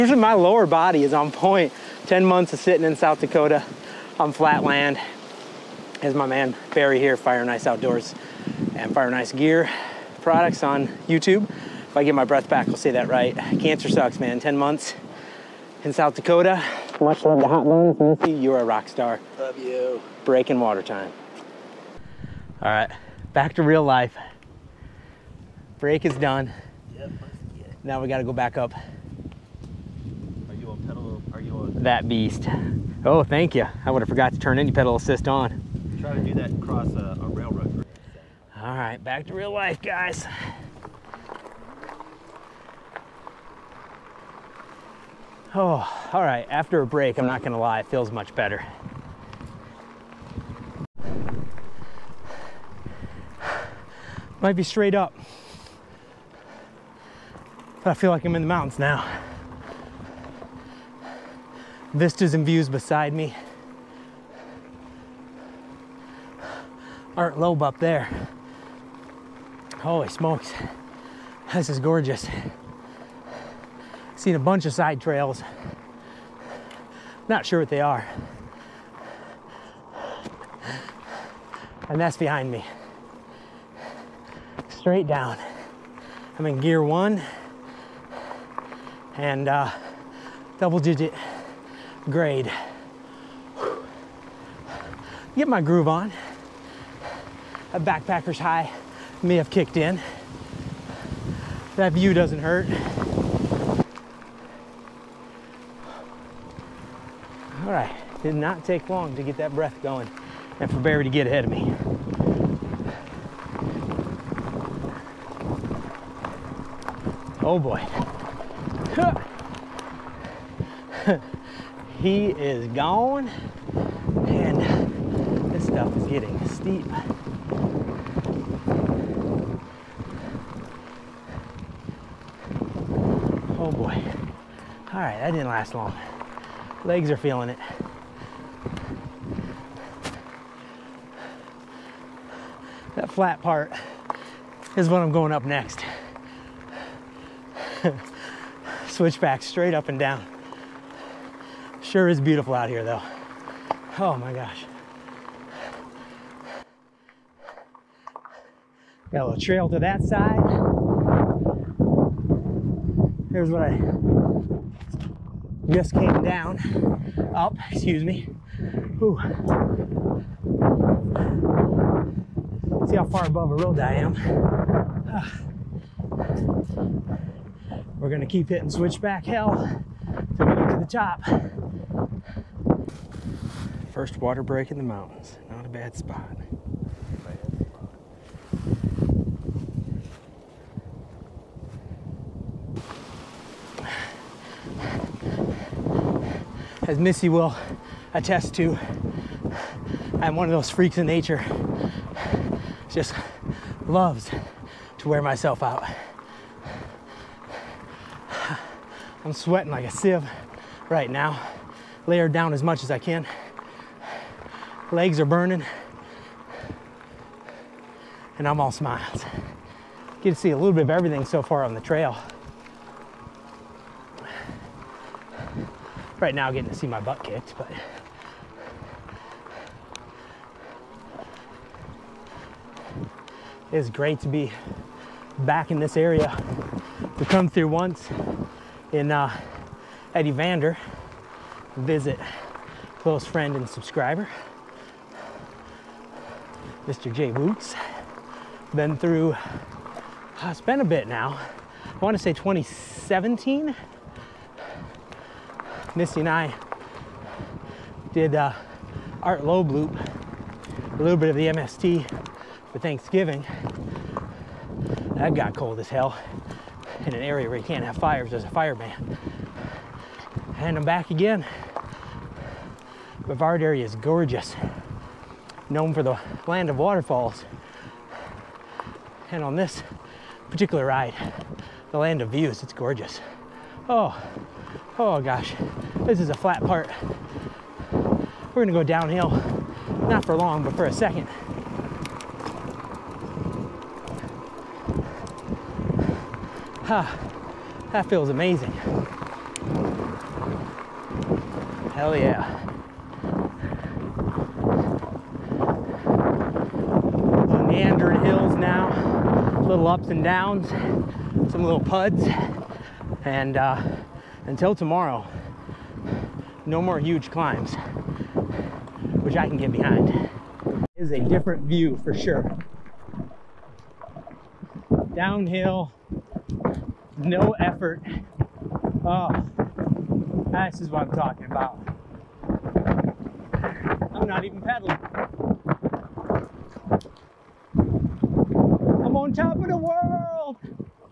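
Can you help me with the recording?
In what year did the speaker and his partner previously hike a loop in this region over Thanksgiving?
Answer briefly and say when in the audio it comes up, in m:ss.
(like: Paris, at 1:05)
2017, at 4:12.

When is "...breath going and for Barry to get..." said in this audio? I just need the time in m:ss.
1:49.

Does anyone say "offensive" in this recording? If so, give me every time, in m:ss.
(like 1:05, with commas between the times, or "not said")
not said.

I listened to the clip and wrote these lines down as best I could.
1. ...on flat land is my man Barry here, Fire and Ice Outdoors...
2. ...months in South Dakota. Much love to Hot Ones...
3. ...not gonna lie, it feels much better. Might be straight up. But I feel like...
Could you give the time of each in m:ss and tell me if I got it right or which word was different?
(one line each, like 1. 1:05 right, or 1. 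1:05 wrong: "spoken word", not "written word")
1. 0:04 right
2. 0:14 right
3. 0:47 right.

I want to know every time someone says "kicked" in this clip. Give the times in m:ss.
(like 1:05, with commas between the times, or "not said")
1:39, 3:47.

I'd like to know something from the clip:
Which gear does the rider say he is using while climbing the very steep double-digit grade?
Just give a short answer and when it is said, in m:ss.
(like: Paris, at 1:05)
gear one, at 1:26.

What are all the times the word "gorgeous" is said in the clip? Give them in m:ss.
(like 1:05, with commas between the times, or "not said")
1:11, 4:33, 4:42.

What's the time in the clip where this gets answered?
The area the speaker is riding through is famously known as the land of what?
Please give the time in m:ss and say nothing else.
4:36.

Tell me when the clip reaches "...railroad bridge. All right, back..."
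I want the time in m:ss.
0:37.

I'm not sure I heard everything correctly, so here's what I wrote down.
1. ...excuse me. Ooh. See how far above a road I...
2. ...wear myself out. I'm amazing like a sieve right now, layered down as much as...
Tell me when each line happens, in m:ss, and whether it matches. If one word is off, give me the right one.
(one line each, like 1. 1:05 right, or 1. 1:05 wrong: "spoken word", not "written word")
1. 2:47 right
2. 3:25 wrong: "sweating", not "amazing".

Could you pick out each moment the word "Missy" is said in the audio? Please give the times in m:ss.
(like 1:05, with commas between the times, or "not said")
0:18, 3:16, 4:15.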